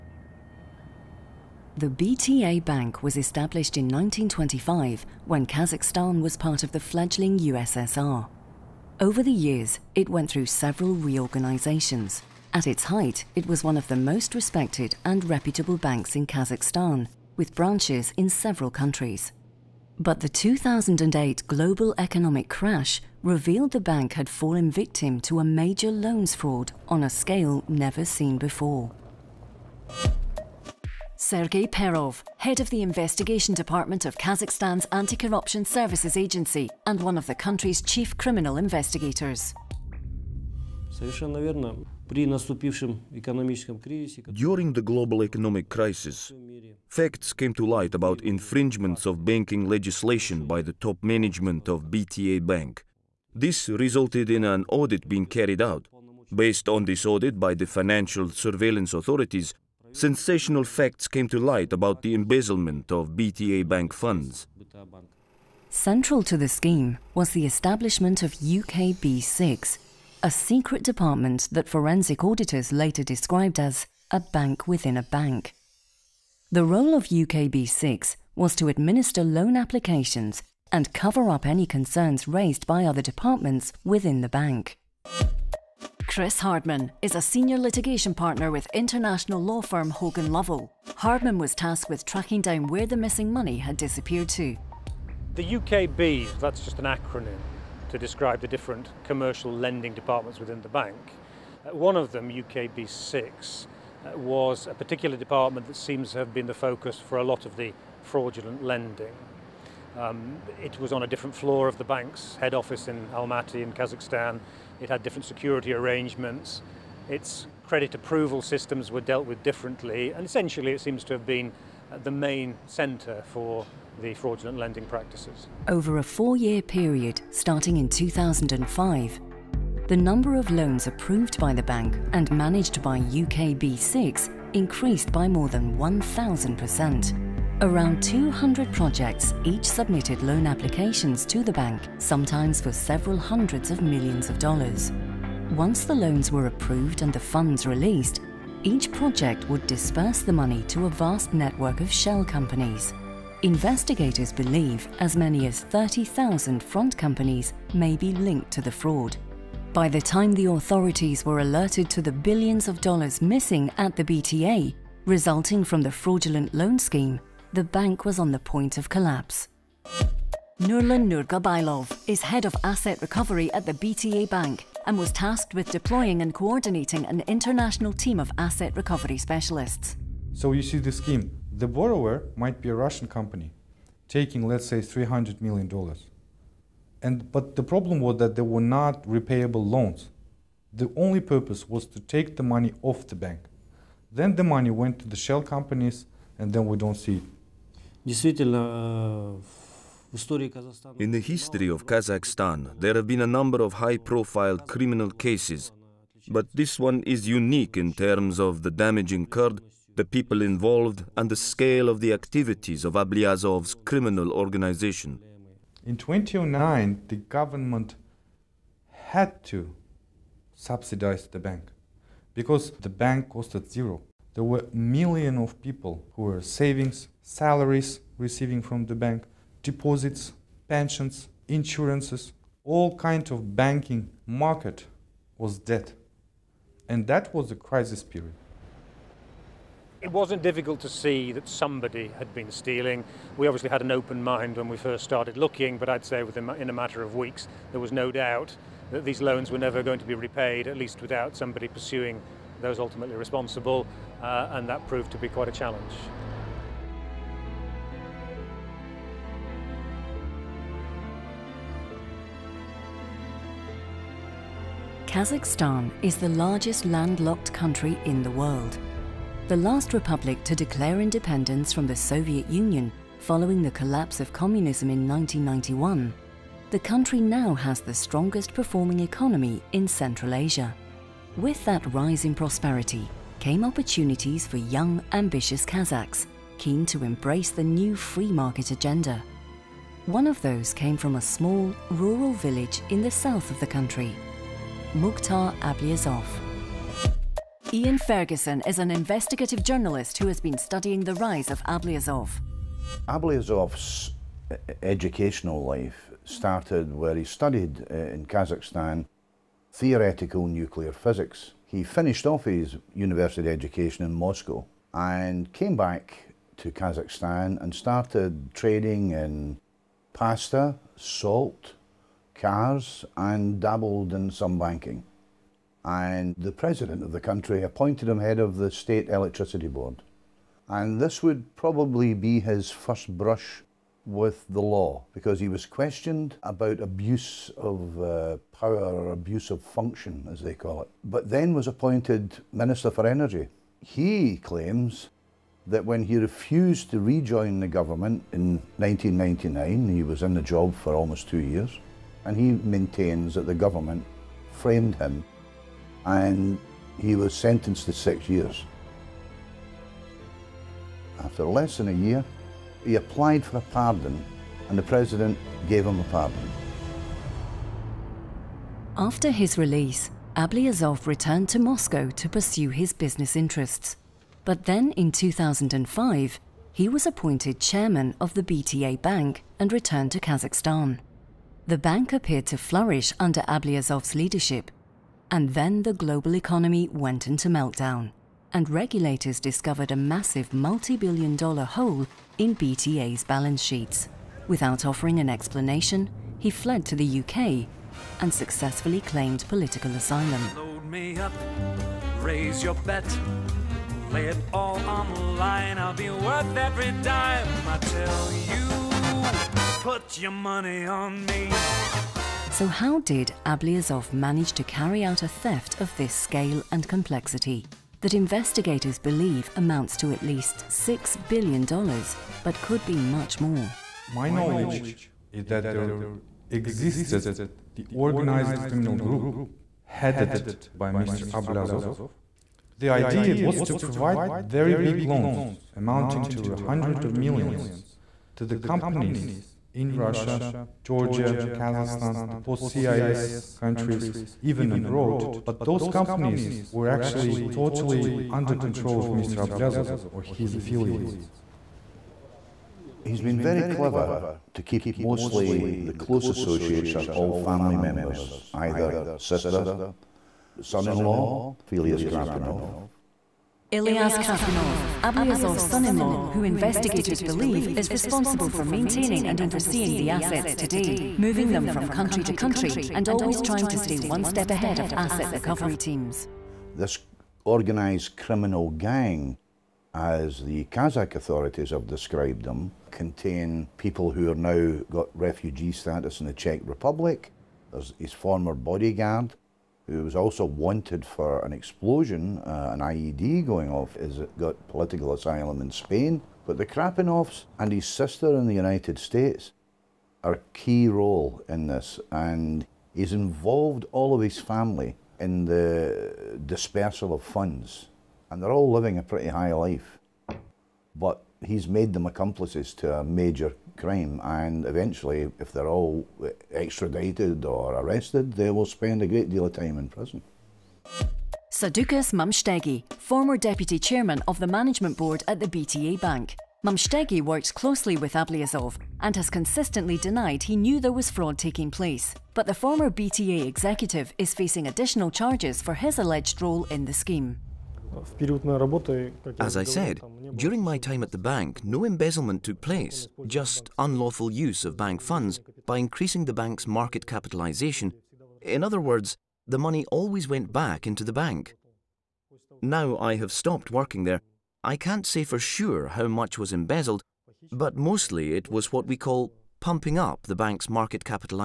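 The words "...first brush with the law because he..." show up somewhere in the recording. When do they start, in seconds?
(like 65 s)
332 s.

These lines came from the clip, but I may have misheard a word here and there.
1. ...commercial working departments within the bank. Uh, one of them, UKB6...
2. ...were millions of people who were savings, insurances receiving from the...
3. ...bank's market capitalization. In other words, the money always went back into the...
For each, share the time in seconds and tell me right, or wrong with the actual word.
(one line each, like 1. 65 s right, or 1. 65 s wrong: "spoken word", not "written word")
1. 99 s wrong: "lending", not "working"
2. 224 s wrong: "salaries", not "insurances"
3. 546 s right.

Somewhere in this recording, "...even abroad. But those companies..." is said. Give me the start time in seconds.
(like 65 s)
444 s.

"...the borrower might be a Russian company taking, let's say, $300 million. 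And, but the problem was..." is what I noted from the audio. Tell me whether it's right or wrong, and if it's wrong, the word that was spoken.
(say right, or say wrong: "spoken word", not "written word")
right.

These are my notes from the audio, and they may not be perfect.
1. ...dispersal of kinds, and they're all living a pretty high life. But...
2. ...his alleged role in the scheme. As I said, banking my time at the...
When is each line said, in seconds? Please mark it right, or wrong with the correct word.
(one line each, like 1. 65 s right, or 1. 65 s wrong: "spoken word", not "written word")
1. 506 s wrong: "funds", not "kinds"
2. 535 s wrong: "during", not "banking".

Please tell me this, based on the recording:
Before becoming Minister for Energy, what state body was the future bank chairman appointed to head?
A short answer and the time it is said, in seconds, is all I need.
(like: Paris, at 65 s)
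State Electricity Board, at 328 s.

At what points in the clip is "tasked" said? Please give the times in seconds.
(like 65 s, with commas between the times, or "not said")
91 s, 175 s.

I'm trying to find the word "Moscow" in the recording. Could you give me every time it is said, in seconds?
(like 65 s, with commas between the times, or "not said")
314 s, 371 s.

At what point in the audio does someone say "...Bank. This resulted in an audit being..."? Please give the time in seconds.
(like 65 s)
52 s.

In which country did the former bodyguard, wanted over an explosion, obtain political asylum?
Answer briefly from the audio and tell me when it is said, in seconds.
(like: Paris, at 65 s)
Spain, at 495 s.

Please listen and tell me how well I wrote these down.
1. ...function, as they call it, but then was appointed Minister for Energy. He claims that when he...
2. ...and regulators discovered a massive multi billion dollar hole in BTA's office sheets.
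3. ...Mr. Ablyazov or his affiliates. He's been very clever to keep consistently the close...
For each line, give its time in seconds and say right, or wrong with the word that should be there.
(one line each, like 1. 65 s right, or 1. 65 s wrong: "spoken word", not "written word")
1. 339 s right
2. 388 s wrong: "balance", not "office"
3. 449 s wrong: "mostly", not "consistently".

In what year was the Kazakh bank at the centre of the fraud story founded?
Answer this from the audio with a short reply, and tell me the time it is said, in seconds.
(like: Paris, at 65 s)
1925, at 3 s.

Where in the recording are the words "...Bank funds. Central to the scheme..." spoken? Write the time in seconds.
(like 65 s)
63 s.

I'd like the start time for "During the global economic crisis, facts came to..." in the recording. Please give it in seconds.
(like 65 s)
42 s.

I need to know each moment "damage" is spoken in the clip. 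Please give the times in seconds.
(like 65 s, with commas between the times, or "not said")
208 s.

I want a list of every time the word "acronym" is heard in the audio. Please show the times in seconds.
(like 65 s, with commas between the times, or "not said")
96 s.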